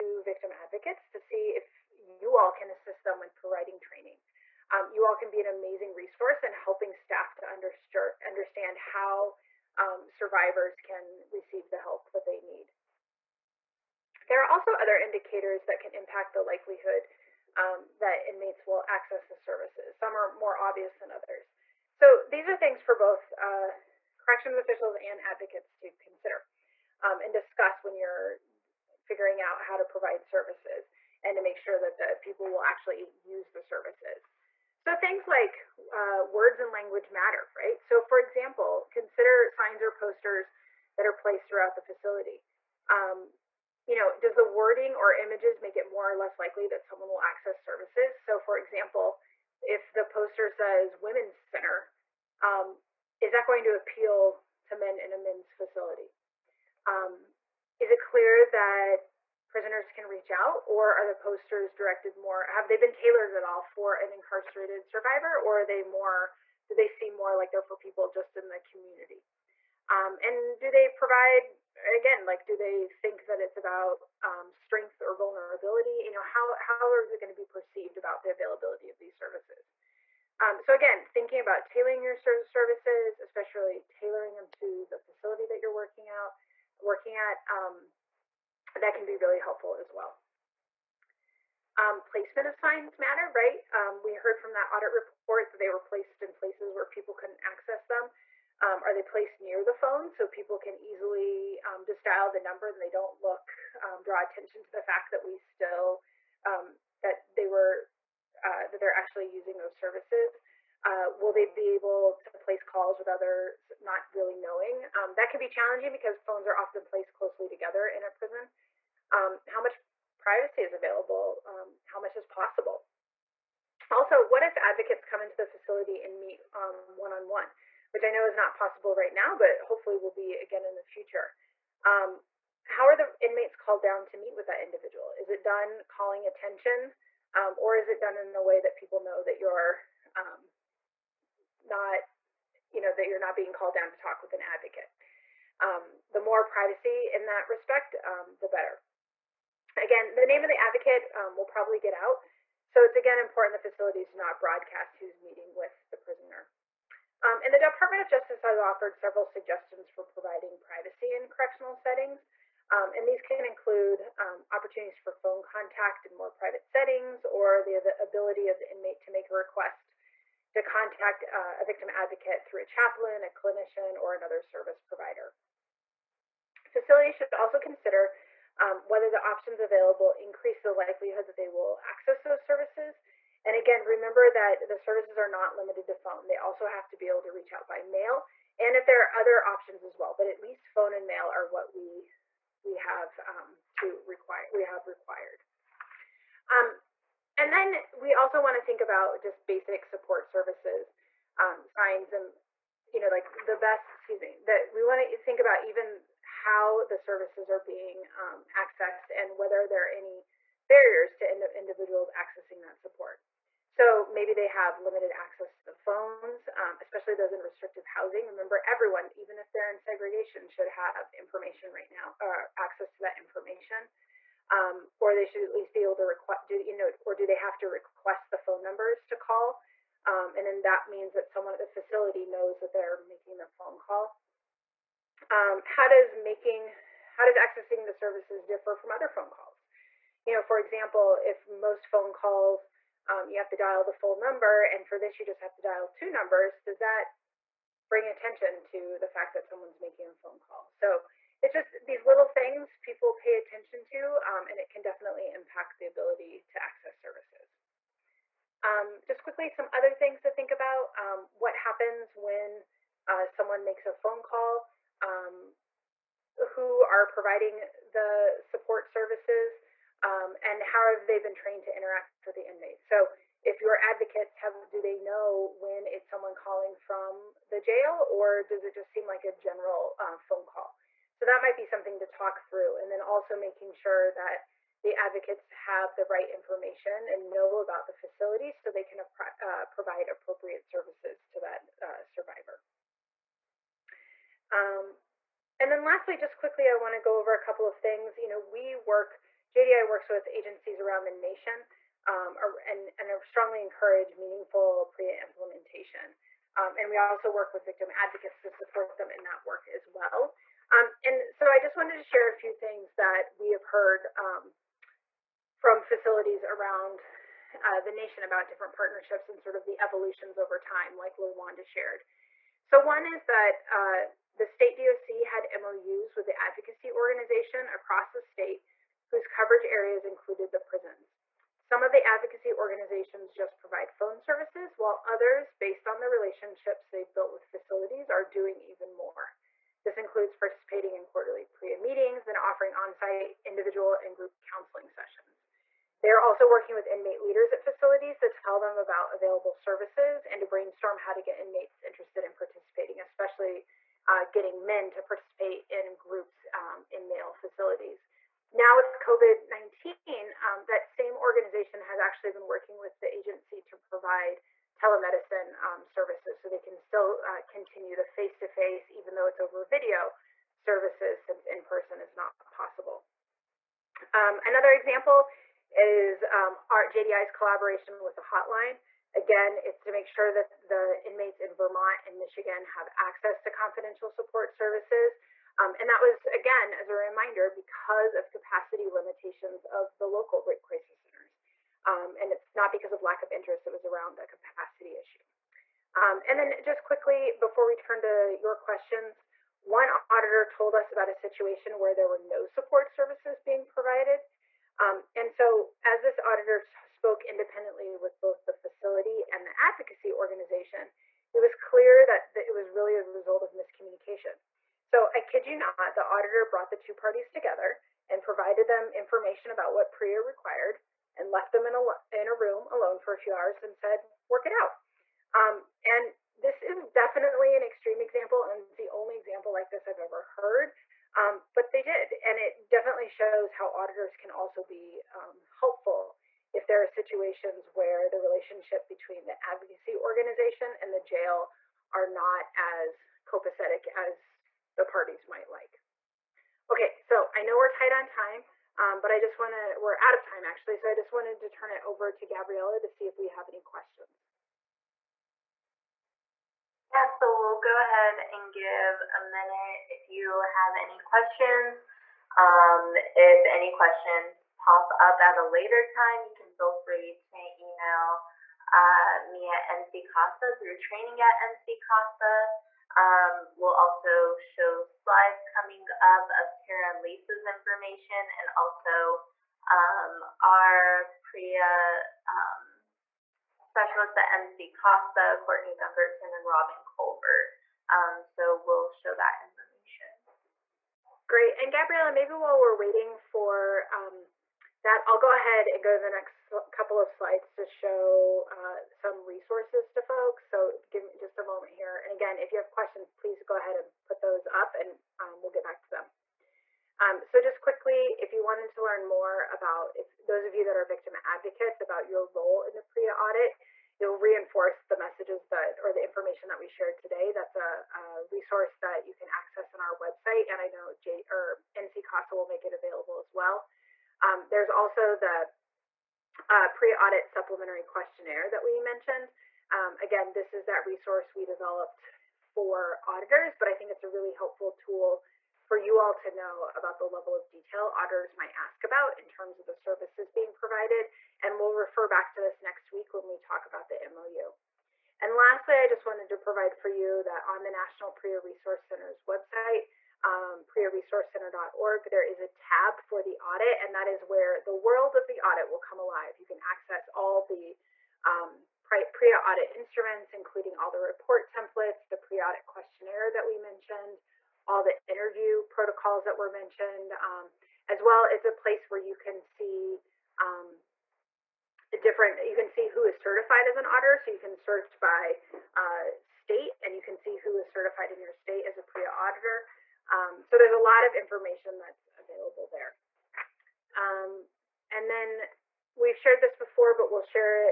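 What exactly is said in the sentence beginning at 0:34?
So things like uh, words and language matter, right?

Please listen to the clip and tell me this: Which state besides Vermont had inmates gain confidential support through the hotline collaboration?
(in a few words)
Michigan.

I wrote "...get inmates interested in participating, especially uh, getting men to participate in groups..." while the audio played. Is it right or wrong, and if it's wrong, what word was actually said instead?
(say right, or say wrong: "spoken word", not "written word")
right.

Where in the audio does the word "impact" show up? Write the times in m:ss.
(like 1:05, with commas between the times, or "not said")
0:15, 4:15.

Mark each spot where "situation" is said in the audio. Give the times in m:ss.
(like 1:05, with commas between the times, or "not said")
6:41, 7:16.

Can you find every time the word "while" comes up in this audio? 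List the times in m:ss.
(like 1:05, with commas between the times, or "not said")
5:34, 8:12.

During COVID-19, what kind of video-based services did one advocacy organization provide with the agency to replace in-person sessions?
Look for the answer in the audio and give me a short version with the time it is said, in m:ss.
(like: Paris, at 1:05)
Telemedicine, at 6:04.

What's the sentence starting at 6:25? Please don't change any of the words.
Um, and that was, again, as a reminder, because of capacity limitations of the local rape crisis centers.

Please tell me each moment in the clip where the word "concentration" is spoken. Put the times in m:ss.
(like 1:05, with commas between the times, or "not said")
not said.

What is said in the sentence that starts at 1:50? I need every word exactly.
Uh, will they be able to place calls with others not really knowing?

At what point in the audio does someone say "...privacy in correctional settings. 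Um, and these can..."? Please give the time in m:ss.
2:40.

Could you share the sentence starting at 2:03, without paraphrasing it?
Also, what if advocates come into the facility and meet one-on-one?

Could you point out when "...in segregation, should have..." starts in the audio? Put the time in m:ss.
3:39.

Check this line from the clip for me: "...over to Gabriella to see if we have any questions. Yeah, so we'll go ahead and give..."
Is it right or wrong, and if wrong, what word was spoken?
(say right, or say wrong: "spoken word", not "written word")
right.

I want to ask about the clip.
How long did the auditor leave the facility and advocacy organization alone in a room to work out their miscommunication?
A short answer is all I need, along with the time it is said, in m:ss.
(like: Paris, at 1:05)
A few hours, at 7:03.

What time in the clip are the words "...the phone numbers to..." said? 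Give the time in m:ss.
3:48.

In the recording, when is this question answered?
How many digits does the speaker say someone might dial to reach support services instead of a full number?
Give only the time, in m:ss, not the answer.
4:05.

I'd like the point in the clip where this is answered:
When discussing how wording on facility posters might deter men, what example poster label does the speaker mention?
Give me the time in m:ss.
0:50.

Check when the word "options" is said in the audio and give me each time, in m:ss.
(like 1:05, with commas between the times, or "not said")
2:59, 3:09.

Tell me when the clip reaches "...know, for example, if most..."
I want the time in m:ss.
4:00.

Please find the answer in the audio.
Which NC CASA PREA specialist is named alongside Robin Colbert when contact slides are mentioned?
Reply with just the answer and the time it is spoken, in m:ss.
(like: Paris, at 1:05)
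Courtney Dunkerton, at 8:05.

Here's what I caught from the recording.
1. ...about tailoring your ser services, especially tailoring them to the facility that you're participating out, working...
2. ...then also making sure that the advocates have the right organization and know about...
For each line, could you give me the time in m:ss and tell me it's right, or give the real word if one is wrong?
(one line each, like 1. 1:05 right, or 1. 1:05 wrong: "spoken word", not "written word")
1. 1:21 wrong: "working", not "participating"
2. 4:42 wrong: "information", not "organization".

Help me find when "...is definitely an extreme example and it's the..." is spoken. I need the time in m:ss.
7:06.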